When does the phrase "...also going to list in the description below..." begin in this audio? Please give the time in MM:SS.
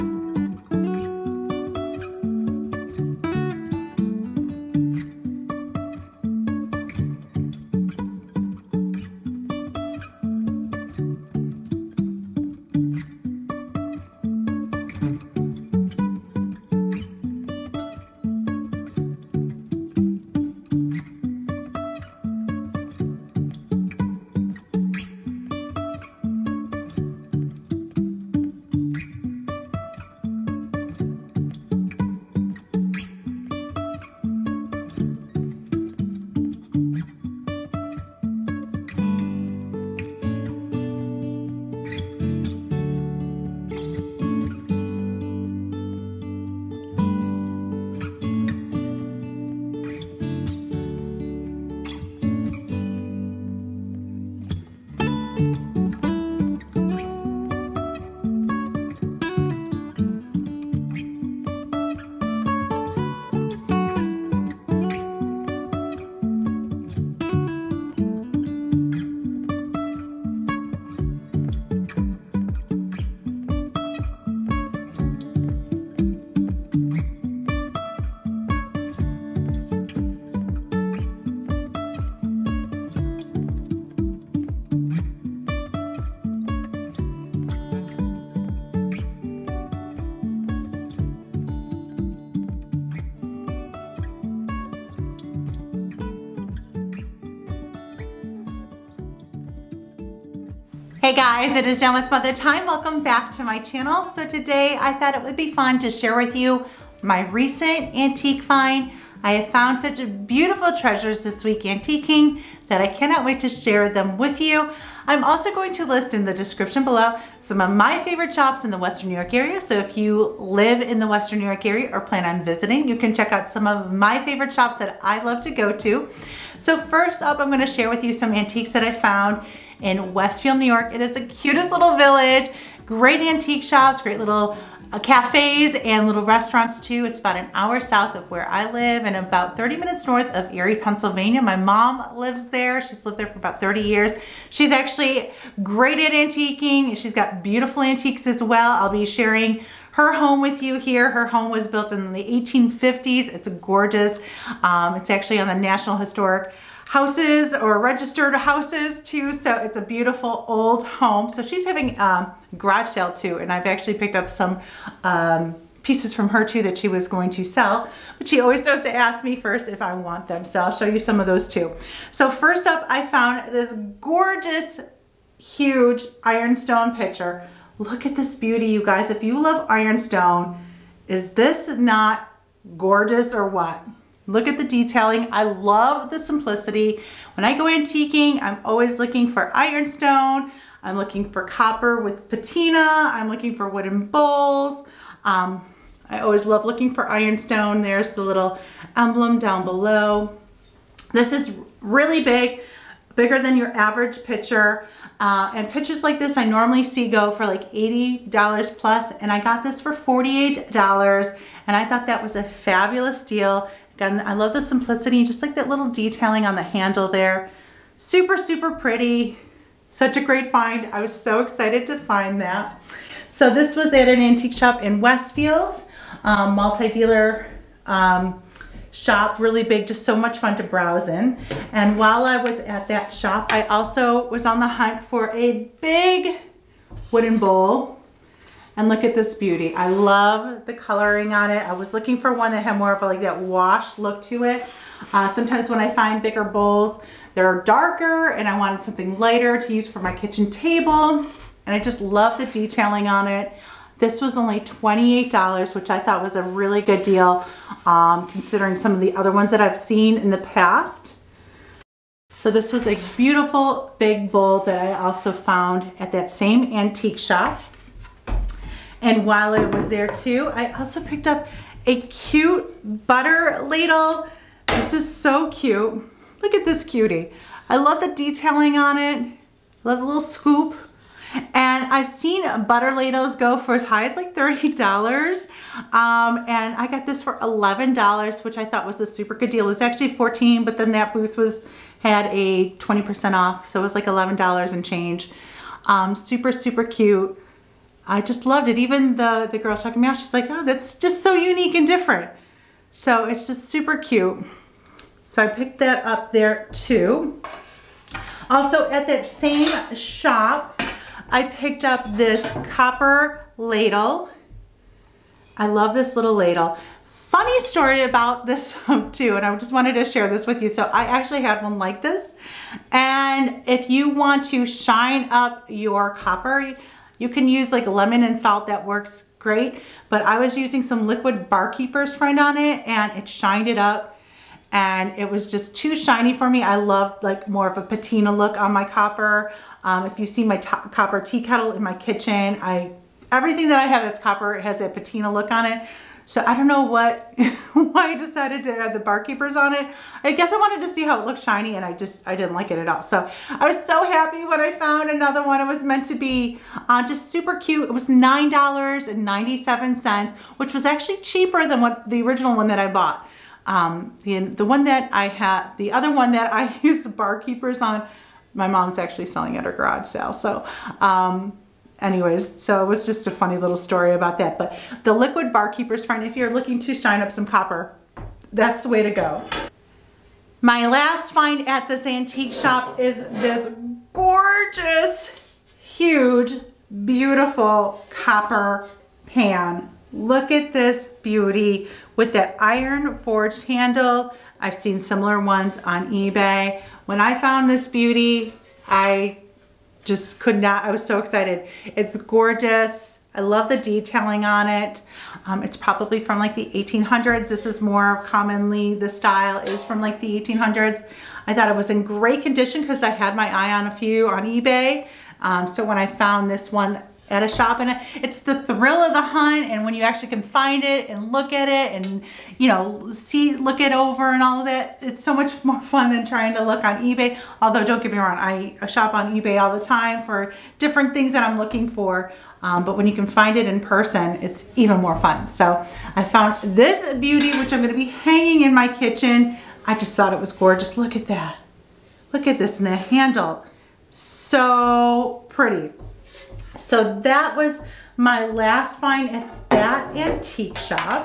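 01:55.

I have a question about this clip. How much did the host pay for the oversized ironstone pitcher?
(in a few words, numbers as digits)
$48.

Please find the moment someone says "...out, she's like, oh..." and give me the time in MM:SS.
05:00.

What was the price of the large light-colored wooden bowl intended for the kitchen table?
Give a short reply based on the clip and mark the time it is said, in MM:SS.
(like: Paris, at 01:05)
$28, at 04:14.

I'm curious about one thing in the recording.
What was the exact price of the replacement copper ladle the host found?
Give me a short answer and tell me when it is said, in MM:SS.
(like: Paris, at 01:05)
$9.97, at 05:58.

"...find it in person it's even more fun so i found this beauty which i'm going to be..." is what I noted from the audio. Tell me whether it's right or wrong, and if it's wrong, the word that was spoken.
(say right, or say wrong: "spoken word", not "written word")
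right.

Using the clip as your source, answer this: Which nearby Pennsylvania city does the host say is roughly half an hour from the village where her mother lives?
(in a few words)
Erie.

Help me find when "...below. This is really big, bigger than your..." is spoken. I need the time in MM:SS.
03:19.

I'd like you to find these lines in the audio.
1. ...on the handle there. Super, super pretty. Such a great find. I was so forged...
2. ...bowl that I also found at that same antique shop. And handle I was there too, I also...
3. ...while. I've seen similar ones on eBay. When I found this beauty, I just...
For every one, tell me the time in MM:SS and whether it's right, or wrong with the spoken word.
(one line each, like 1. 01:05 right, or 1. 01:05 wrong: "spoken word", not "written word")
1. 03:36 wrong: "excited", not "forged"
2. 04:24 wrong: "while", not "handle"
3. 06:33 wrong: "handle", not "while".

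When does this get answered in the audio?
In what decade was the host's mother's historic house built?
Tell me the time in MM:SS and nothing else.
02:32.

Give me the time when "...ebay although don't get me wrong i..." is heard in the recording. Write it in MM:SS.
07:07.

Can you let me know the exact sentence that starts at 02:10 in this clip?
It is the cutest little village, great antique shops, great little uh, cafes and little restaurants too.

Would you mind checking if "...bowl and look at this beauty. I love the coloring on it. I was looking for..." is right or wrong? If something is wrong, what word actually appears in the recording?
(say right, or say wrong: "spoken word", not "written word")
right.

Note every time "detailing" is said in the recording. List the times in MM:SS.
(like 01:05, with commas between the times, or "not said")
03:04, 03:35, 04:12, 04:38, 06:43.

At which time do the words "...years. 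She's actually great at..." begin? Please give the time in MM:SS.
02:23.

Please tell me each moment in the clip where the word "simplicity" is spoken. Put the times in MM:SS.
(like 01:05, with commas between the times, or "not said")
03:06, 03:34.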